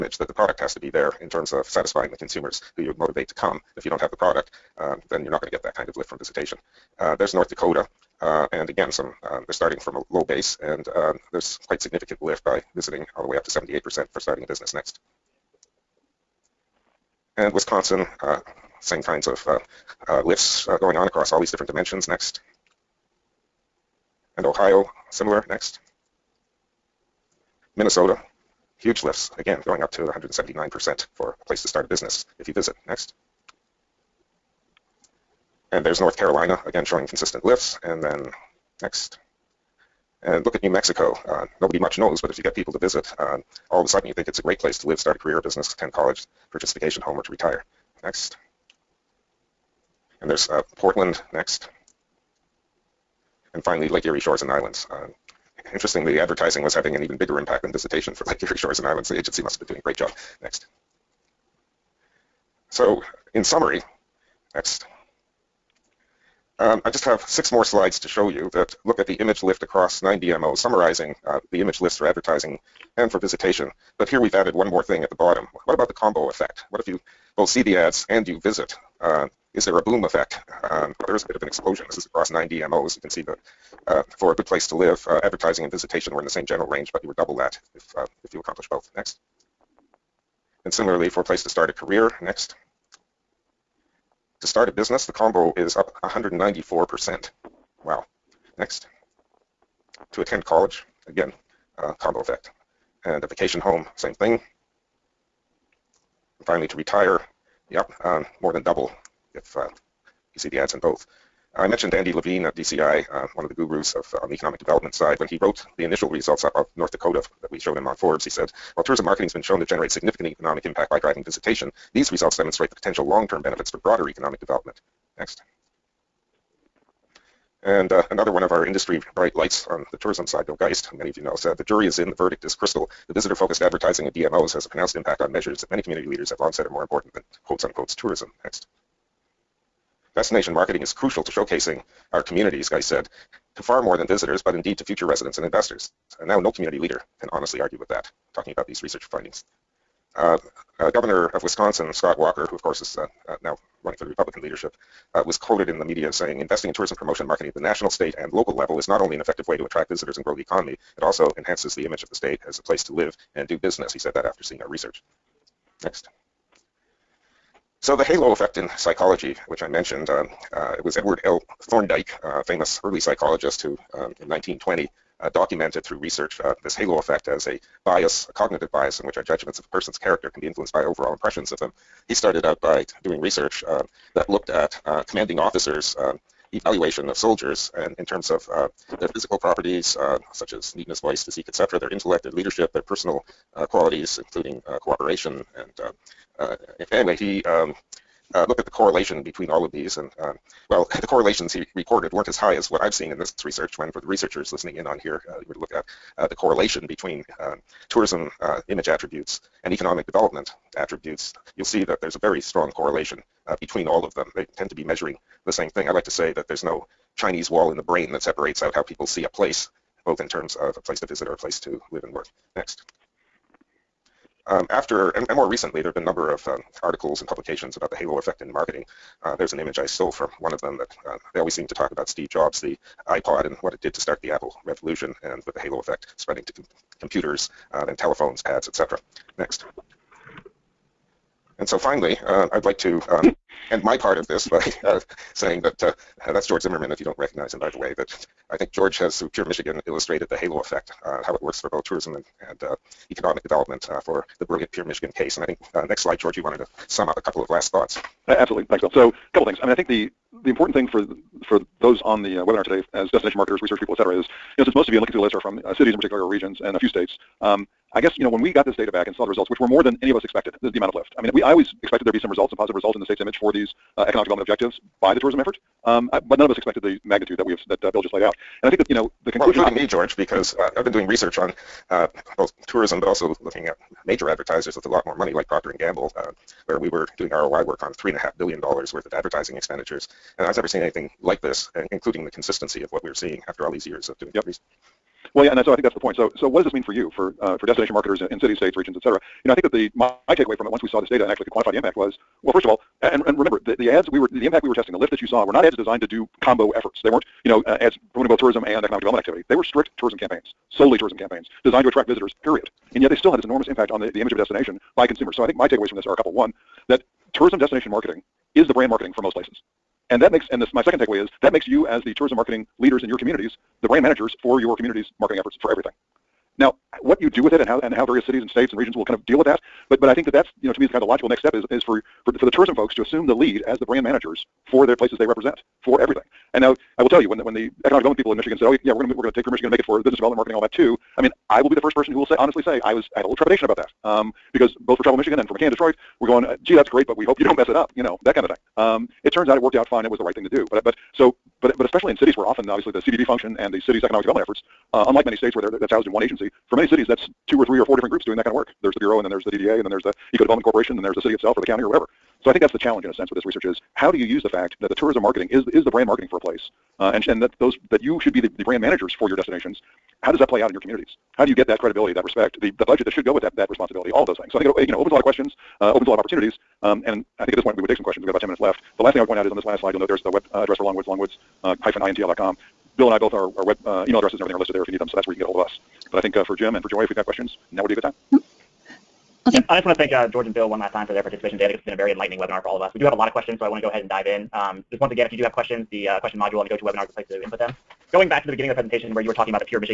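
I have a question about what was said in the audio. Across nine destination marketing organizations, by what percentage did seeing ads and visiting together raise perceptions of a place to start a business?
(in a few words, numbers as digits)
194%.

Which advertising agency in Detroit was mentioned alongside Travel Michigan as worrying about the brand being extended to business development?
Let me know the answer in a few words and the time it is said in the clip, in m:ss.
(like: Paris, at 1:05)
McCann Detroit, at 5:45.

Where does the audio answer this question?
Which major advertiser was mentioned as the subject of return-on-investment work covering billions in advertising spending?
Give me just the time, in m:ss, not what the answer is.
4:45.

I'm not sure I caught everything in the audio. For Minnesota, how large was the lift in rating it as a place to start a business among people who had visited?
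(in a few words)
179%.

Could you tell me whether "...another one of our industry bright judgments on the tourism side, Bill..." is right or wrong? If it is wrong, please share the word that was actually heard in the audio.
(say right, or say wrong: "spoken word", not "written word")
wrong: "lights", not "judgments".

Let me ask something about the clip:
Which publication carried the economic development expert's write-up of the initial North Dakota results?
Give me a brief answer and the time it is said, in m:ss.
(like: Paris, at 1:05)
Forbes, at 1:57.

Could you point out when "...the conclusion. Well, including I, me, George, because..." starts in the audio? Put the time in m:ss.
4:39.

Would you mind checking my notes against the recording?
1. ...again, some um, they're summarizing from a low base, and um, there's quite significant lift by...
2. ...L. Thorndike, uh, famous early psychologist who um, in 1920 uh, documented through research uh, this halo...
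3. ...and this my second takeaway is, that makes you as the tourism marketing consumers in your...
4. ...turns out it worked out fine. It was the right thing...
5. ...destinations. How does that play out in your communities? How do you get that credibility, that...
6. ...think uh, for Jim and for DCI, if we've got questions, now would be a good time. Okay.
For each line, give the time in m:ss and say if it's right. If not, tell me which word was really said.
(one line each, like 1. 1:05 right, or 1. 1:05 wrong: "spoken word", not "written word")
1. 0:08 wrong: "starting", not "summarizing"
2. 2:51 right
3. 5:20 wrong: "leaders", not "consumers"
4. 5:49 right
5. 6:09 right
6. 6:26 wrong: "Joy", not "DCI".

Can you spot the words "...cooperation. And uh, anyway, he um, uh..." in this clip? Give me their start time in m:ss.
3:14.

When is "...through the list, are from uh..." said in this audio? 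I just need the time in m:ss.
4:25.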